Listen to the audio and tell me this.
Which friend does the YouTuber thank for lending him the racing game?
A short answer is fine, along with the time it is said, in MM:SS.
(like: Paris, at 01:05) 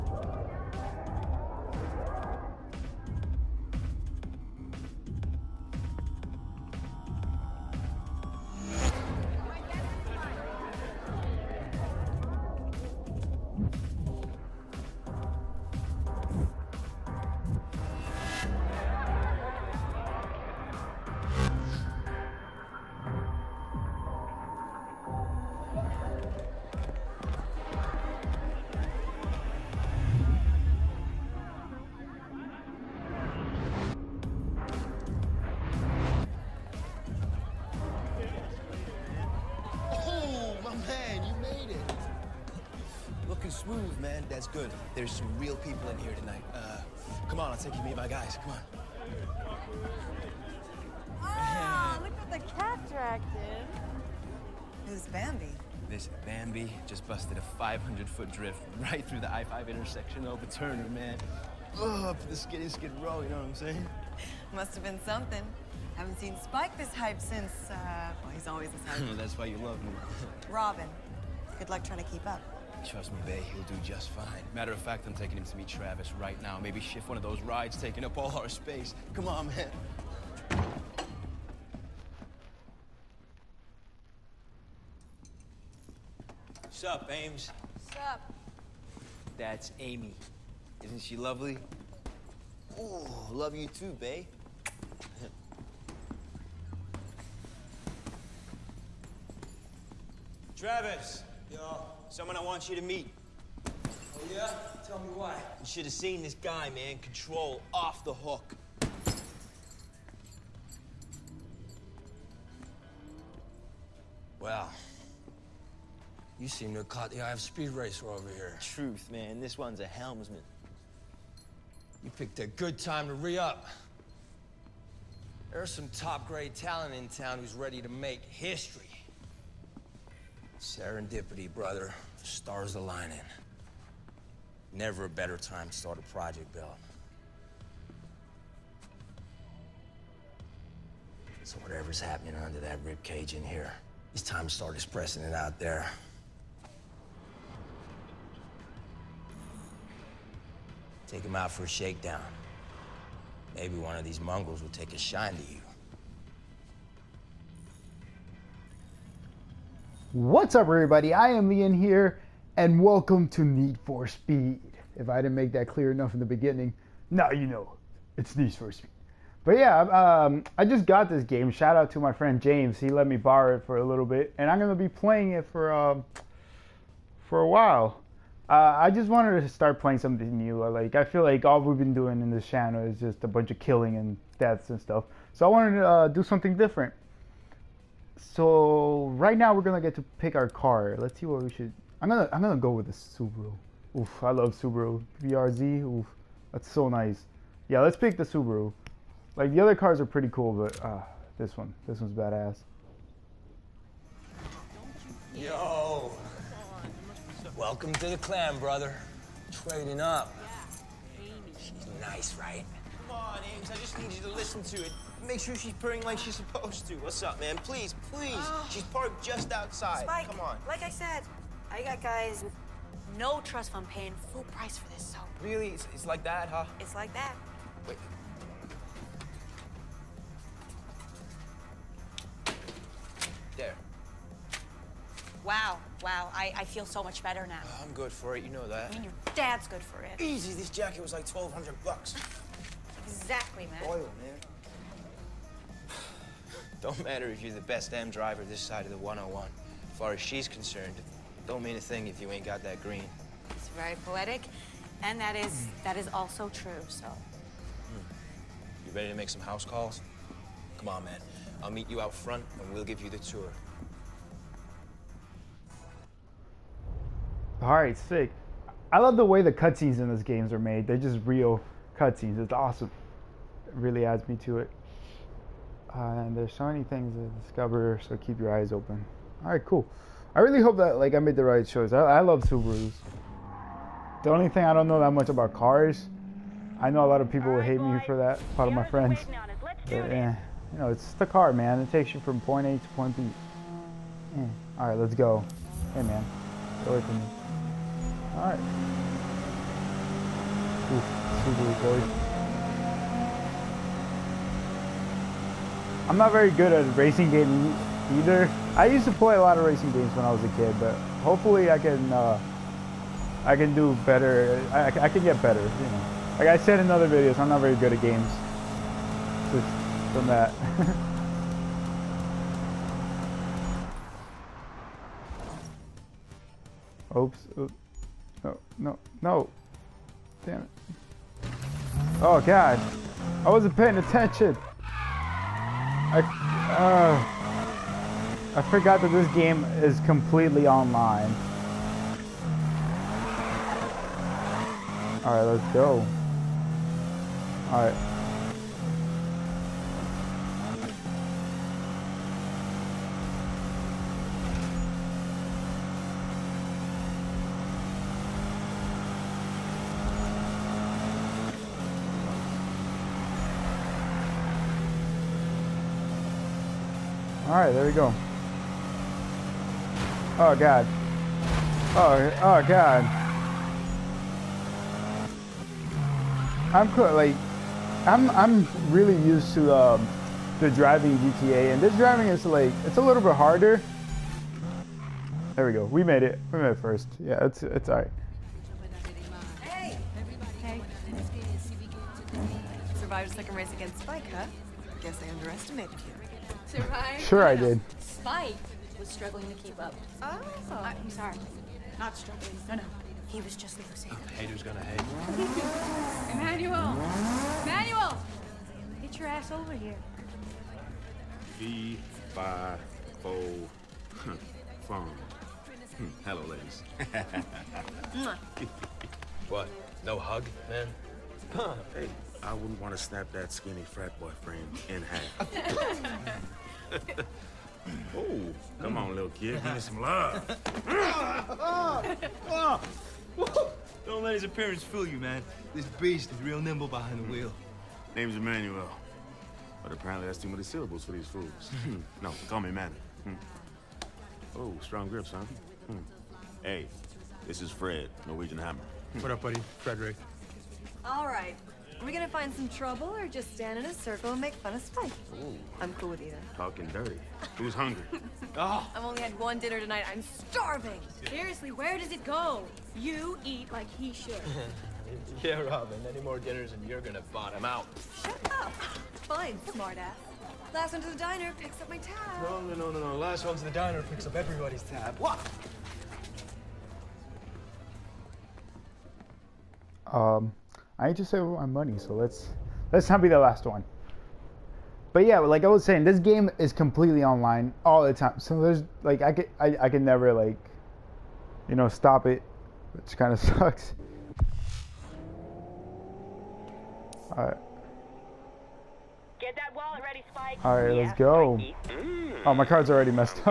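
James, at 02:52.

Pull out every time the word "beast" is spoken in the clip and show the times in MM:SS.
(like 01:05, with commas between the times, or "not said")
07:15.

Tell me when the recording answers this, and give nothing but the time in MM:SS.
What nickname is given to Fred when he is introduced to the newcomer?
07:28.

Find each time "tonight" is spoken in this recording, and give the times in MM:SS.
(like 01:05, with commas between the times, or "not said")
00:46, 07:39.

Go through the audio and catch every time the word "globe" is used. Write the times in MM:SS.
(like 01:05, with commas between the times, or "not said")
not said.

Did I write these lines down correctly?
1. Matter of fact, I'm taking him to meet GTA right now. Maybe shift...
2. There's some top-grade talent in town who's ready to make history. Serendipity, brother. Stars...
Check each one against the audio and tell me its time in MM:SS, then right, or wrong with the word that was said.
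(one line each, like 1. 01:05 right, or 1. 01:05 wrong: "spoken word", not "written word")
1. 01:14 wrong: "Travis", not "GTA"
2. 02:05 right.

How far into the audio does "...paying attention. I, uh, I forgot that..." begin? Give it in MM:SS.
05:33.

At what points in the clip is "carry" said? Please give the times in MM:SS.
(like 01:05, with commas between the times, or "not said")
not said.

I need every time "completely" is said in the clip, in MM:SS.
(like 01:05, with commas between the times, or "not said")
05:40, 08:06.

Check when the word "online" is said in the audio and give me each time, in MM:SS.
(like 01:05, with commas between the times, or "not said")
05:40, 08:07.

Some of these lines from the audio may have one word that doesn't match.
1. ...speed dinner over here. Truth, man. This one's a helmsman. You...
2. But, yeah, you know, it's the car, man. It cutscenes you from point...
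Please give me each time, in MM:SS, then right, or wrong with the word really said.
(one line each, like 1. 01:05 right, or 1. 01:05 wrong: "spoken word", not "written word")
1. 01:57 wrong: "racer", not "dinner"
2. 04:49 wrong: "takes", not "cutscenes".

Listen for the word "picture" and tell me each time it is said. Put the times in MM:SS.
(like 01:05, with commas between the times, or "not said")
not said.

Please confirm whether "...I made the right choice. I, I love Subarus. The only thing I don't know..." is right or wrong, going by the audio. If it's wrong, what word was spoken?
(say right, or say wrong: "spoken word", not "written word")
right.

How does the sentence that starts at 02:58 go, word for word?
Uh, I just wanted to start playing something new.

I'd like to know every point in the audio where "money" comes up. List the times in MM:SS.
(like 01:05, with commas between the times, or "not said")
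08:01.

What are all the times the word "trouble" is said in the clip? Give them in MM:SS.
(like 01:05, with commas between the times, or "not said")
07:32.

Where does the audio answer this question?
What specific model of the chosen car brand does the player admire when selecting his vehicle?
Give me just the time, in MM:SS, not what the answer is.
03:15.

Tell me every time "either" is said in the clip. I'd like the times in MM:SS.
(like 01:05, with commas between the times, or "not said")
05:08, 07:36.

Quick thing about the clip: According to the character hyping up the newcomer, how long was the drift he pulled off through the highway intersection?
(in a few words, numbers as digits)
500-foot.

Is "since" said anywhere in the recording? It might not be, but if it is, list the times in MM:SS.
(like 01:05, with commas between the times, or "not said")
01:07.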